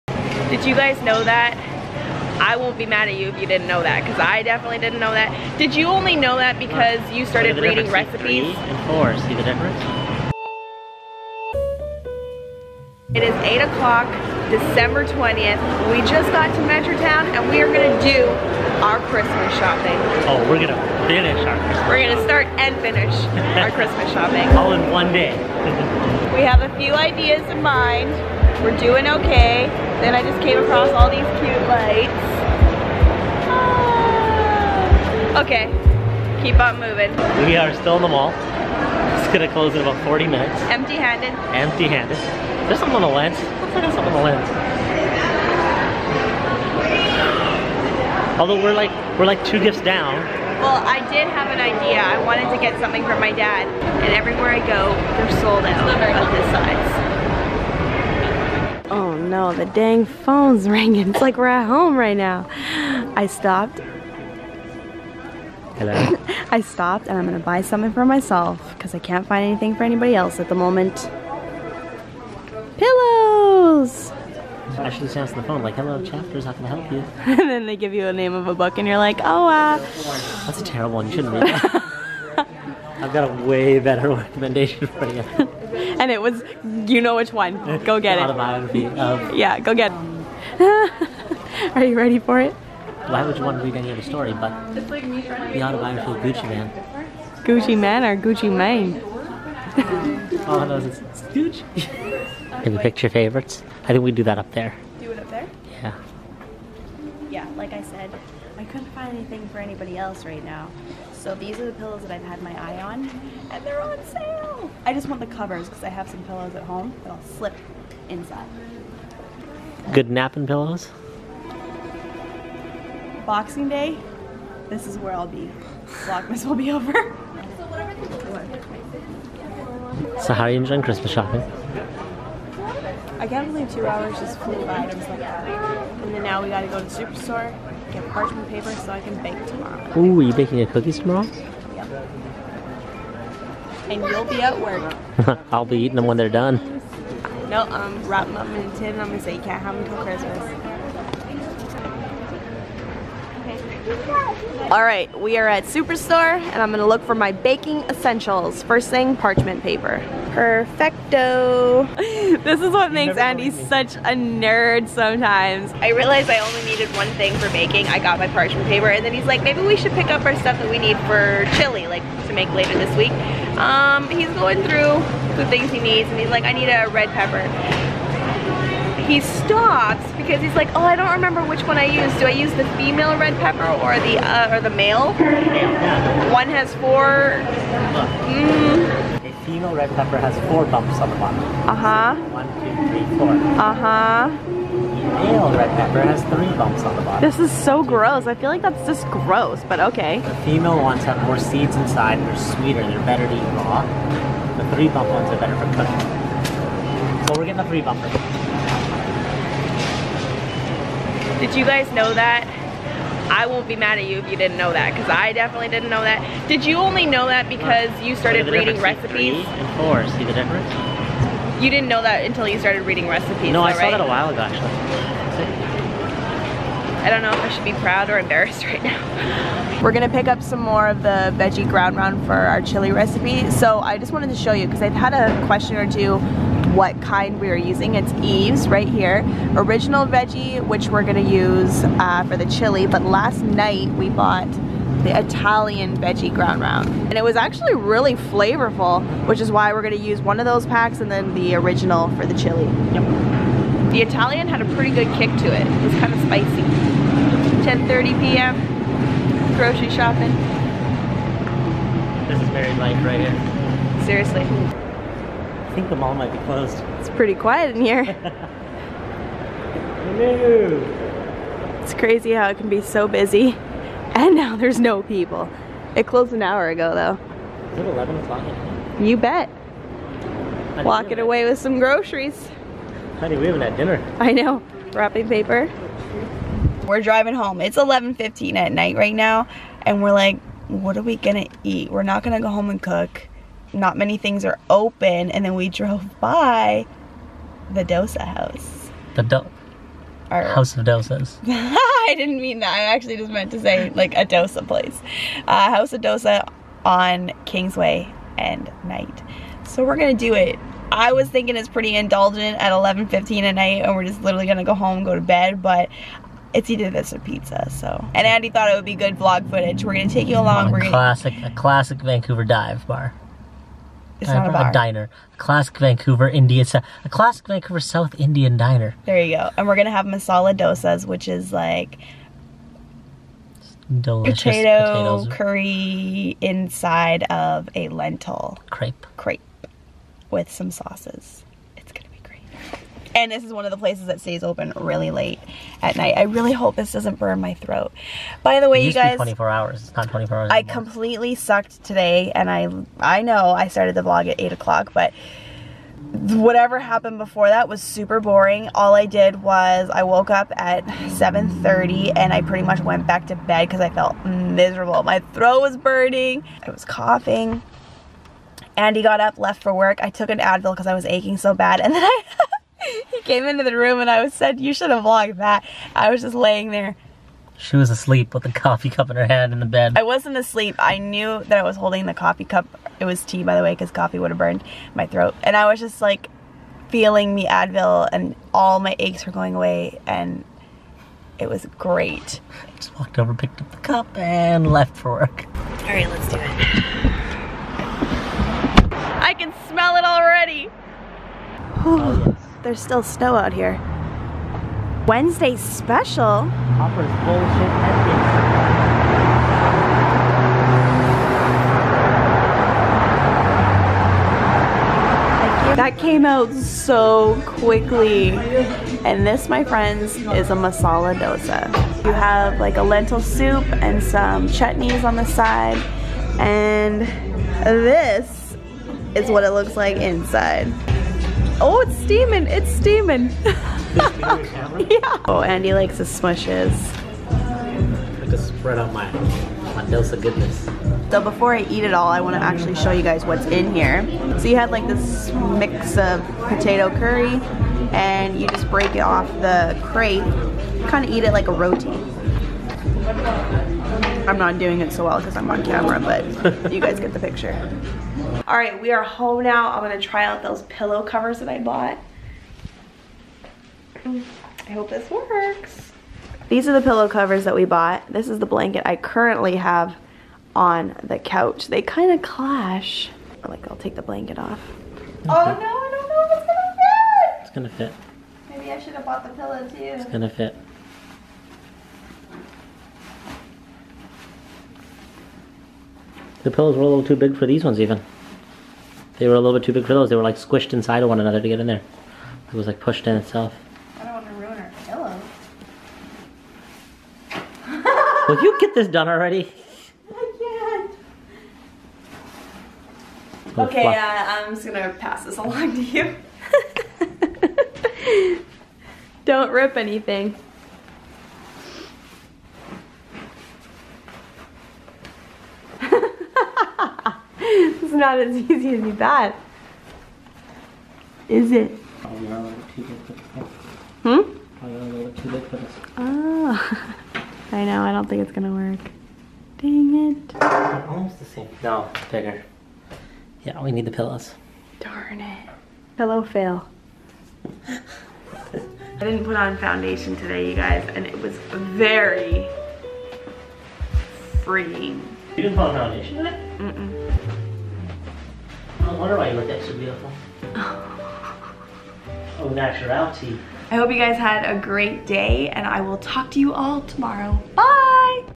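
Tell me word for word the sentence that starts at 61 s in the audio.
It's like we're at home right now.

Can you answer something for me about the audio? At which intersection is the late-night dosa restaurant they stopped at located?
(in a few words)
Kingsway and Knight.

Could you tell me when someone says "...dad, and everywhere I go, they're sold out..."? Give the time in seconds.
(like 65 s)
53 s.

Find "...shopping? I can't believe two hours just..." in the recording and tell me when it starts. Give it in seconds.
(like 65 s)
131 s.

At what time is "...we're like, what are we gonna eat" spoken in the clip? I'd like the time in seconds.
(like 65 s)
290 s.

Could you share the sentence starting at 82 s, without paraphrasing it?
I've got a way better recommendation for you and it was, you know which one.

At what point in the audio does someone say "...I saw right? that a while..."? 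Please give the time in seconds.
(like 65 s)
223 s.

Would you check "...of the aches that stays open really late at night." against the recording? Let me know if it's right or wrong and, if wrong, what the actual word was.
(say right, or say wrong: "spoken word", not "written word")
wrong: "places", not "aches".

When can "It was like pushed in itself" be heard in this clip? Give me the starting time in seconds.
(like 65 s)
492 s.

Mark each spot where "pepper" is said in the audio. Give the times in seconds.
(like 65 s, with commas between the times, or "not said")
177 s, 183 s, 189 s, 195 s.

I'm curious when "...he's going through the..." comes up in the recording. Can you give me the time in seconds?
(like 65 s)
174 s.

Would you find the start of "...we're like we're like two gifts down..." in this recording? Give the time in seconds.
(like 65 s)
48 s.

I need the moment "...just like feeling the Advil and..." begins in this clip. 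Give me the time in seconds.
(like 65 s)
385 s.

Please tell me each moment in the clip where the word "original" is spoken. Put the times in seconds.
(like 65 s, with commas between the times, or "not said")
239 s, 251 s.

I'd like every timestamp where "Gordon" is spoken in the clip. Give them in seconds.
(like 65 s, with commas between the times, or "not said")
not said.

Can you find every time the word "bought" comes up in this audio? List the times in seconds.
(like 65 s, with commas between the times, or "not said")
244 s, 461 s, 467 s, 479 s.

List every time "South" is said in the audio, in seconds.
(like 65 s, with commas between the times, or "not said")
327 s.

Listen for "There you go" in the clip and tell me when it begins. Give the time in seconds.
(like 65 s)
329 s.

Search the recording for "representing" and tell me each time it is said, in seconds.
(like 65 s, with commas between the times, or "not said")
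not said.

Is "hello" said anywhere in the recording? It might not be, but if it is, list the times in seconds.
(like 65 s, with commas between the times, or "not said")
65 s, 75 s, 270 s.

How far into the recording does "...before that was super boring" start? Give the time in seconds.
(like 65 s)
357 s.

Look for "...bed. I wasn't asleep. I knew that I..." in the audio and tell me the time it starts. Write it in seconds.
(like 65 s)
379 s.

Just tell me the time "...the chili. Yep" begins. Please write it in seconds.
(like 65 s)
252 s.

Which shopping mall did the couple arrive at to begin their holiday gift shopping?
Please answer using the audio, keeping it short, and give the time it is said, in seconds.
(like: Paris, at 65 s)
Metrotown, at 16 s.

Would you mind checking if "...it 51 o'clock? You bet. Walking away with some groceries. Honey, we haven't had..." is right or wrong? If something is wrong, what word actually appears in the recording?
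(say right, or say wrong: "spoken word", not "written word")
wrong: "11", not "51".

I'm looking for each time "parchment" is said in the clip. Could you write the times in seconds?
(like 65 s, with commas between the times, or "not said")
138 s, 159 s, 168 s.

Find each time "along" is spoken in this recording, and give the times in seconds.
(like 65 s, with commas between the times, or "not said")
320 s, 505 s.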